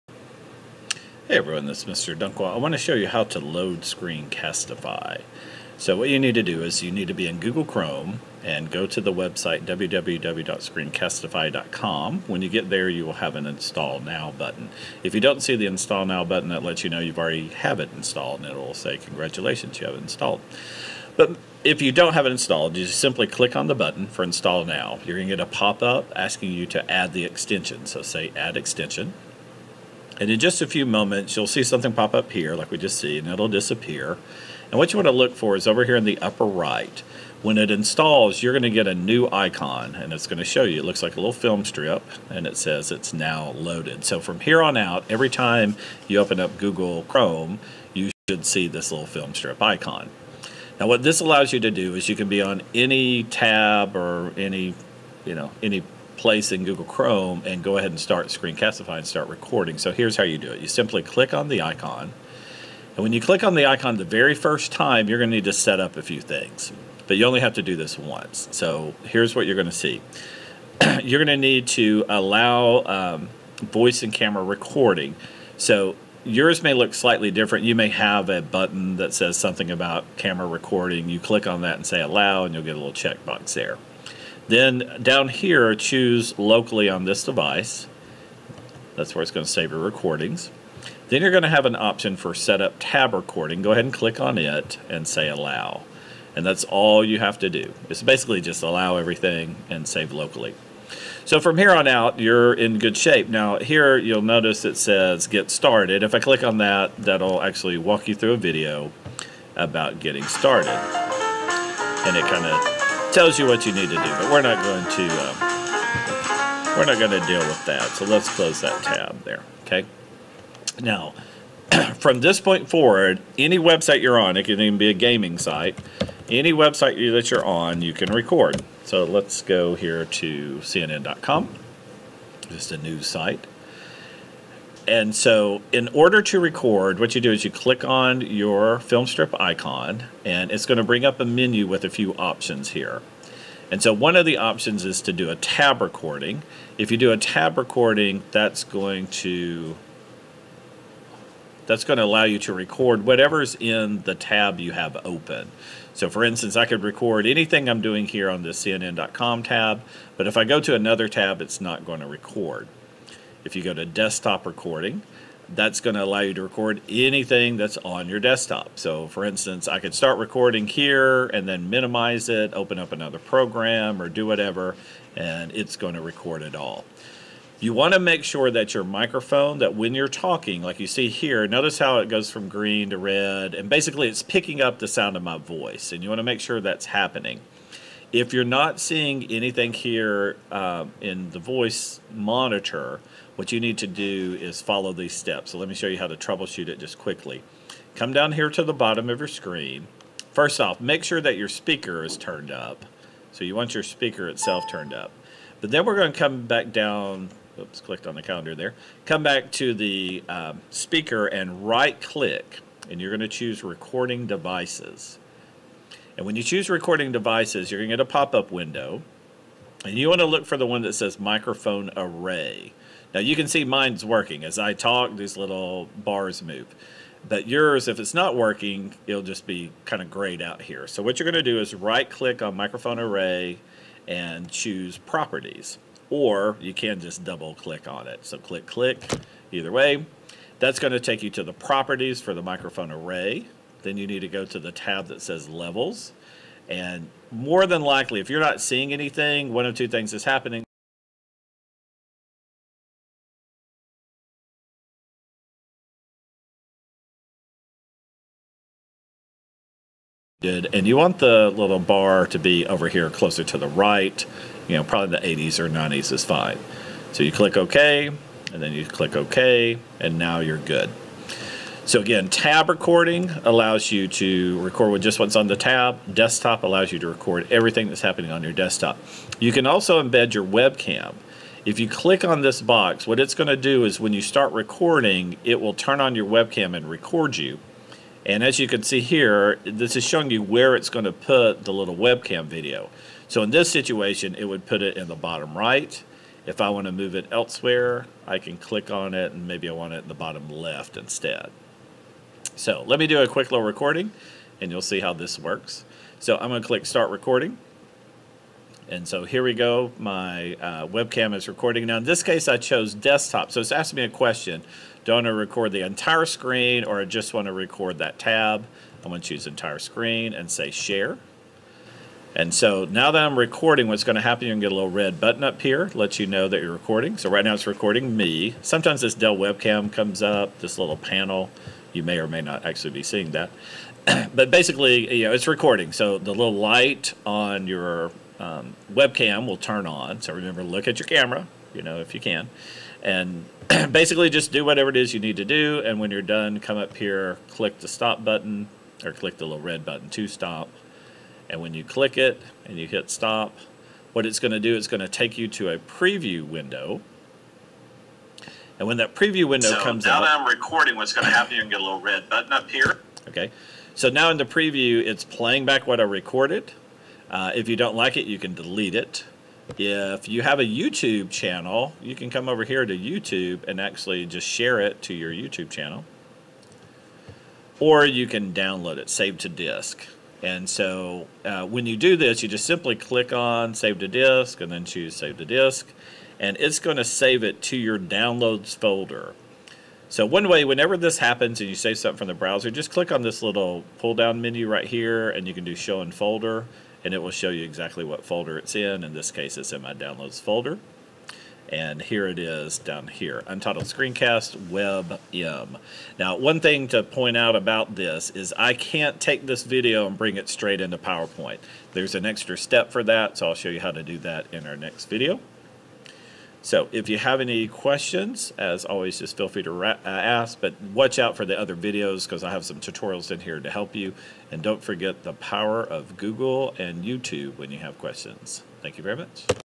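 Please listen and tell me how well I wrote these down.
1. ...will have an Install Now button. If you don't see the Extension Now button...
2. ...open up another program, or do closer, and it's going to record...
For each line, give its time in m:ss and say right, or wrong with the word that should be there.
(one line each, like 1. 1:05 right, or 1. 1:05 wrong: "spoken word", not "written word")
1. 0:13 wrong: "Install", not "Extension"
2. 2:52 wrong: "whatever", not "closer".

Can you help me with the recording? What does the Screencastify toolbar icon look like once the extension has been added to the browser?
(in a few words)
A little film strip.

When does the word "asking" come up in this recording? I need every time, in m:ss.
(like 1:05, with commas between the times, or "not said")
0:26, 5:13.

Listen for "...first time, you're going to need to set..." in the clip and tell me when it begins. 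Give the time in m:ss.
1:04.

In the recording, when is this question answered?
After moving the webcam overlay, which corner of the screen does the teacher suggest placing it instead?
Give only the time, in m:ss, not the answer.
5:00.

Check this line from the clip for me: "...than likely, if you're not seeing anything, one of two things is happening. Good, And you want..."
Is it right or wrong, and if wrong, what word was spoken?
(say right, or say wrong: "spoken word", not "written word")
right.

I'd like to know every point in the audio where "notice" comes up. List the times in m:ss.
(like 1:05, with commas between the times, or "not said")
1:44, 3:01.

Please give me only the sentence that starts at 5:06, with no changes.
So I'm going to click start recording.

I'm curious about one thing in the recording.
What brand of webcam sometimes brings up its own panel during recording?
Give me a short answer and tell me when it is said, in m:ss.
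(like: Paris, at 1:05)
Dell, at 5:29.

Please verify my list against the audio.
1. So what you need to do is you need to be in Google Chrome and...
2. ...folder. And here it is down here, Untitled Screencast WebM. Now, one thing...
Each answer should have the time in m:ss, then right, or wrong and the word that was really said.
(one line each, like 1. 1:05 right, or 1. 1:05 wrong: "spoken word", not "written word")
1. 0:05 right
2. 6:40 right.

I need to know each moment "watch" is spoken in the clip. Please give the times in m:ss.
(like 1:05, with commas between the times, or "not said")
7:00.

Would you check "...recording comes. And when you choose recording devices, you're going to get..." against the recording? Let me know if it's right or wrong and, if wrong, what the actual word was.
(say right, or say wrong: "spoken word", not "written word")
wrong: "devices", not "comes".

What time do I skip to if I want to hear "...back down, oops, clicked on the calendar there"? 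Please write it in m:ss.
3:26.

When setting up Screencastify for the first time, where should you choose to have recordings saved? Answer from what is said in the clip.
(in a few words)
Locally on this device.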